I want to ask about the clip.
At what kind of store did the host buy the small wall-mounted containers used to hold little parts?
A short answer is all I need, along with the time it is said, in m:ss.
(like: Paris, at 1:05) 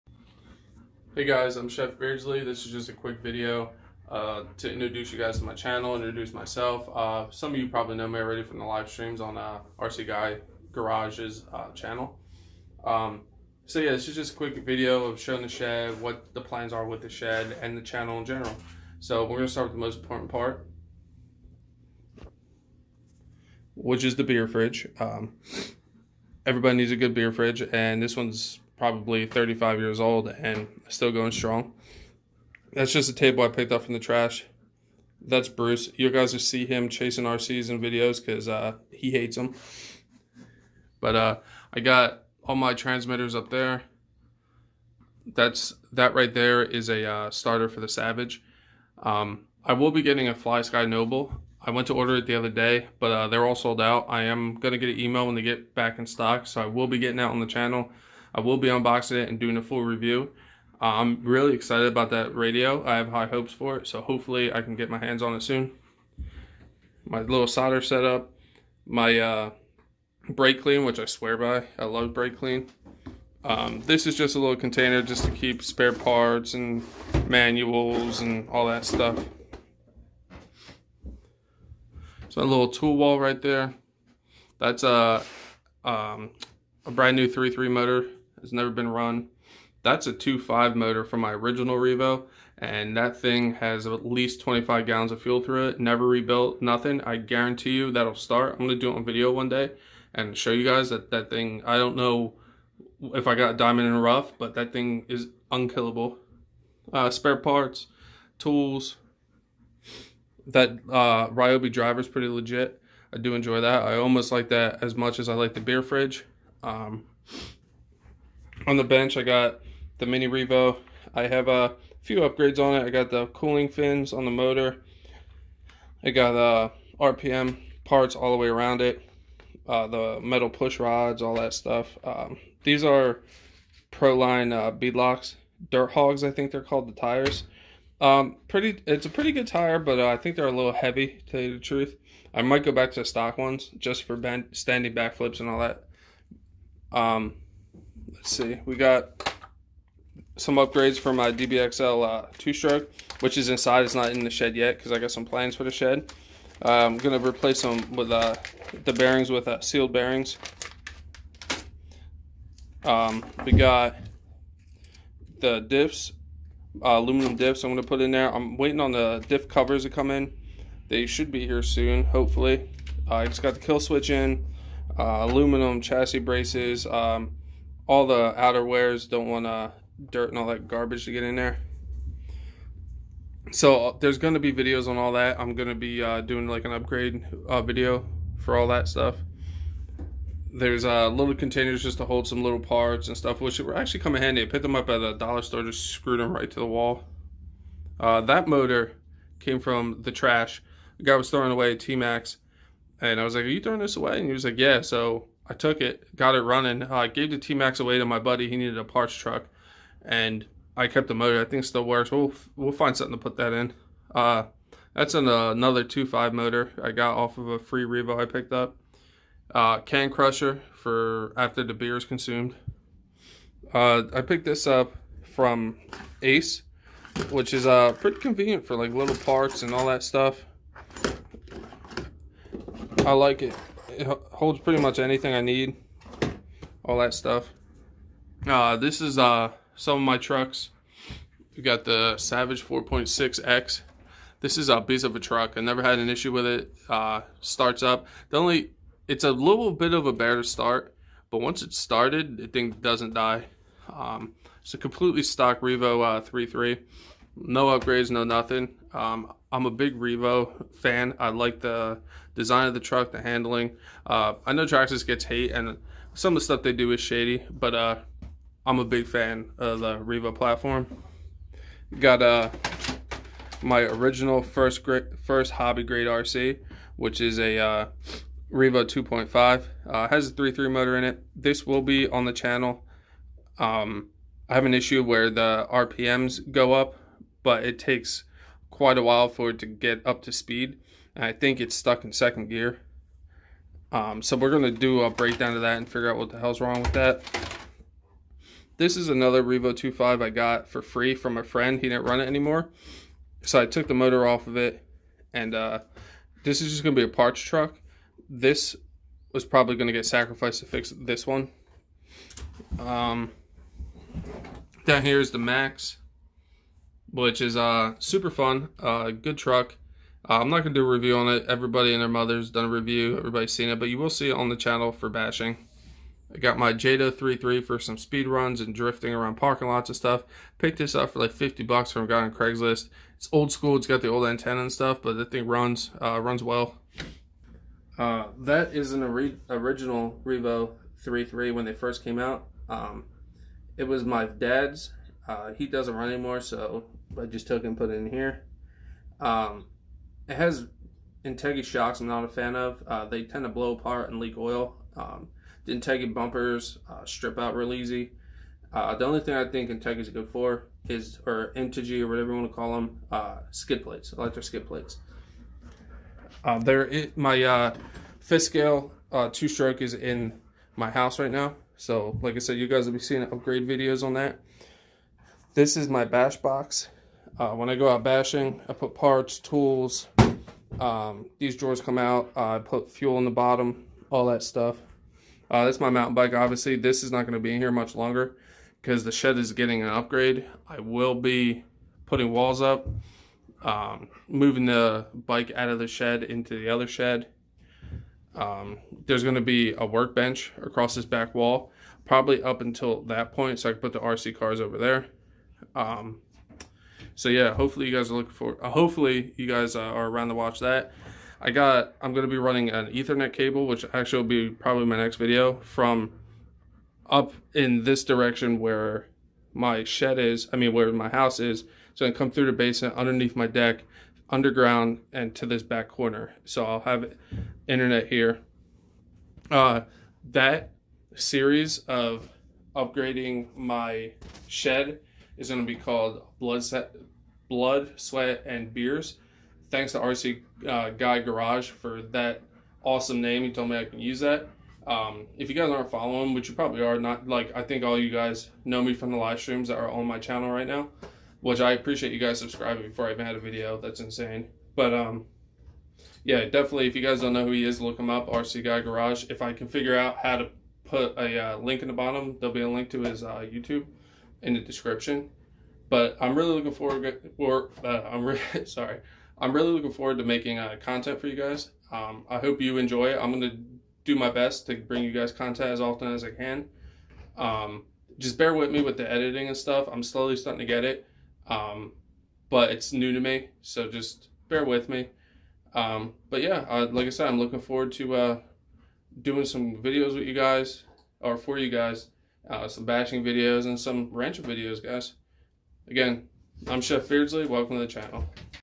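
dollar store, at 3:15.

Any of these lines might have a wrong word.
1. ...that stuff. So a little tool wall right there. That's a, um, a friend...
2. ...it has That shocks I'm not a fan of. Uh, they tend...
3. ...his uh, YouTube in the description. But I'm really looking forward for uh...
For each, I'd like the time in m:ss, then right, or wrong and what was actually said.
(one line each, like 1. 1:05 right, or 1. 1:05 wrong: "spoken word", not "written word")
1. 1:18 wrong: "brand", not "friend"
2. 5:50 wrong: "Integra", not "That"
3. 7:43 right.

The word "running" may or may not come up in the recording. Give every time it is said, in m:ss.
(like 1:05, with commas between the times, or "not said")
3:26, 6:52.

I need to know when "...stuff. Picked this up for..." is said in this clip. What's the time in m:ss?
5:29.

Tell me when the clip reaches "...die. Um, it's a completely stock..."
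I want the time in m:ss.
4:13.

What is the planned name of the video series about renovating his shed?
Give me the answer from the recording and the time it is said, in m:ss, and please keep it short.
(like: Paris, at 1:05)
Blood, Sweat, and Beers, at 7:17.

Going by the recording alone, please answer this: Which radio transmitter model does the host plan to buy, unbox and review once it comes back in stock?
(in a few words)
FlySky Noble.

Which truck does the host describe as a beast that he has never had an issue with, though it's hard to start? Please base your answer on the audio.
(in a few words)
Savage 4.6X.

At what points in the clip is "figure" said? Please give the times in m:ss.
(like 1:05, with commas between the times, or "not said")
4:55, 7:39.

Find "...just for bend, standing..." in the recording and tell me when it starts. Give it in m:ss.
2:23.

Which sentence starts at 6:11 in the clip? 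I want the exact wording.
So, like I said, you guys will be seeing upgrade videos on that.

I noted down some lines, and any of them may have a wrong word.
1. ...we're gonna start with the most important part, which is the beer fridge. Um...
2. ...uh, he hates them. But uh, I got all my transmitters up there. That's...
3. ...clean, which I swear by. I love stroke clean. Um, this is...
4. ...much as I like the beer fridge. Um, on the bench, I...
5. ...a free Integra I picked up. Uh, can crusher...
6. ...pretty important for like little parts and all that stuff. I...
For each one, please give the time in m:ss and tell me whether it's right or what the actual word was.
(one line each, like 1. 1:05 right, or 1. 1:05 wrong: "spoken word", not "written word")
1. 0:19 right
2. 0:38 right
3. 1:10 wrong: "brake", not "stroke"
4. 1:54 right
5. 3:37 wrong: "Revo", not "Integra"
6. 3:47 wrong: "convenient", not "important".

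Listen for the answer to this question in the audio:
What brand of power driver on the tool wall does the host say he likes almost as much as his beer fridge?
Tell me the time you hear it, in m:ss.
1:51.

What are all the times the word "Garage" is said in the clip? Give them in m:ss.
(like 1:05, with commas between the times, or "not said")
0:10, 7:21, 7:38.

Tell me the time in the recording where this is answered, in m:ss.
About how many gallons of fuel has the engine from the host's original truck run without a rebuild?
1:34.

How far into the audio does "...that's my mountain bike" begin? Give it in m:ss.
6:25.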